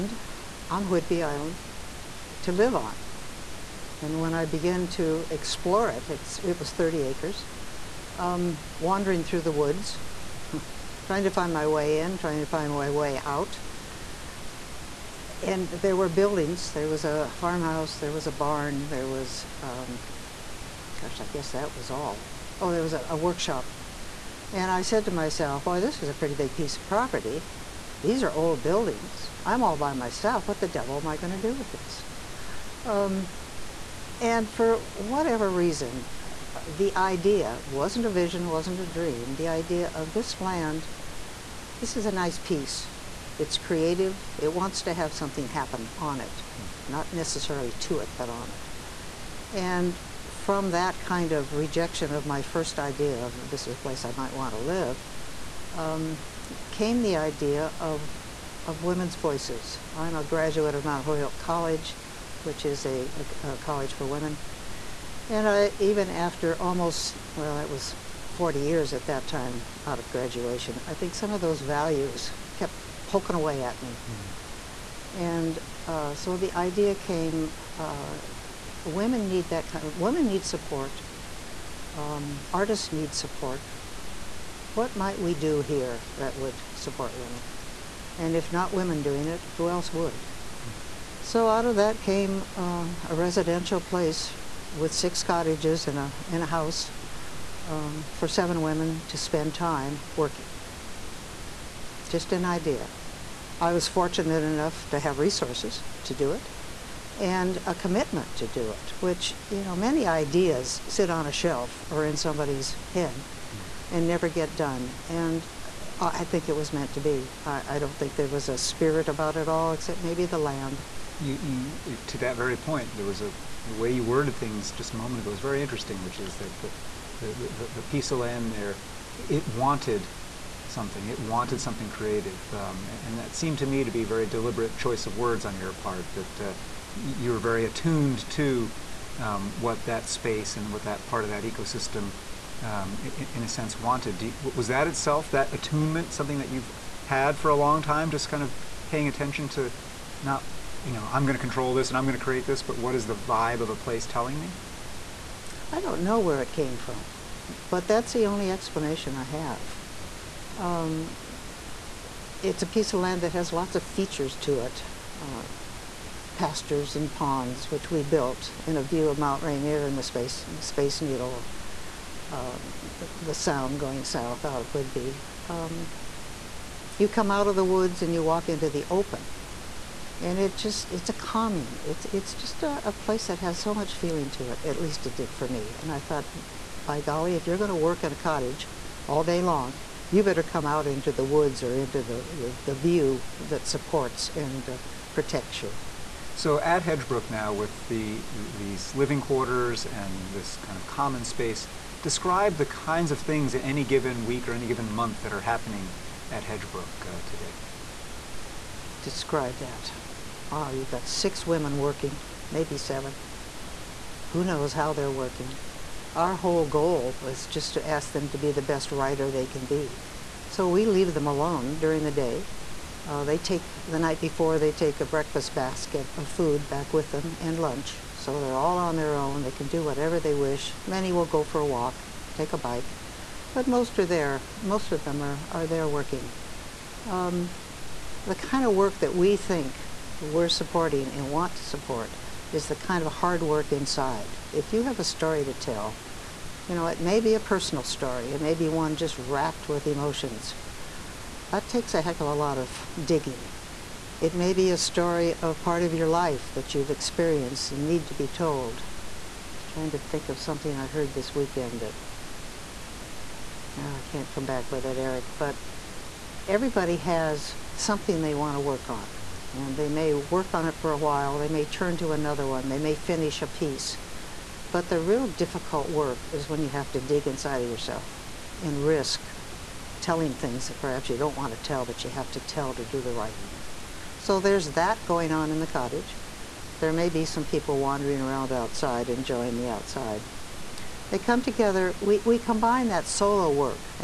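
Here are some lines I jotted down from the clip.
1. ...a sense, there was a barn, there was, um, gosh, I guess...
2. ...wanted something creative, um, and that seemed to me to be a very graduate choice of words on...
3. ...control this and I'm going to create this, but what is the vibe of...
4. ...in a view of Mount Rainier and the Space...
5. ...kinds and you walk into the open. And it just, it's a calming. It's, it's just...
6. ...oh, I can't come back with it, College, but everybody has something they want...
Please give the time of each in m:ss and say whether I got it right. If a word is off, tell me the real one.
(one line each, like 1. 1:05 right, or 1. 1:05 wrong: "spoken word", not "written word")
1. 0:17 wrong: "farmhouse", not "sense"
2. 2:11 wrong: "deliberate", not "graduate"
3. 2:31 right
4. 2:48 right
5. 2:57 wrong: "woods", not "kinds"
6. 4:23 wrong: "Eric", not "College".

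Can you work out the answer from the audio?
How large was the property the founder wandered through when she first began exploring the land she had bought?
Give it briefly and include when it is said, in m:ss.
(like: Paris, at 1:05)
30 acres, at 0:06.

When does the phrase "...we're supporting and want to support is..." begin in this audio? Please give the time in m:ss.
4:00.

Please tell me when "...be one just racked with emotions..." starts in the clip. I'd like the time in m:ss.
4:08.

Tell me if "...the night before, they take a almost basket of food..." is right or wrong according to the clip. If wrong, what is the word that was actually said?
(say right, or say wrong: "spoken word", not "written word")
wrong: "breakfast", not "almost".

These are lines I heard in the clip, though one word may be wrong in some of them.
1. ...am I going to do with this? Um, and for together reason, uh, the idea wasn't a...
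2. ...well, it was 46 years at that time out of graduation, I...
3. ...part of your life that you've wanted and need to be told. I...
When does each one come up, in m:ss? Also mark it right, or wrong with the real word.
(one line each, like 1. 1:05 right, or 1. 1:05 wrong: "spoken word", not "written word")
1. 0:31 wrong: "whatever", not "together"
2. 1:07 wrong: "40", not "46"
3. 4:15 wrong: "experienced", not "wanted".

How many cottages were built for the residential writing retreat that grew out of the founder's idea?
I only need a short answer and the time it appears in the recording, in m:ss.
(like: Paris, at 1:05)
6, at 1:34.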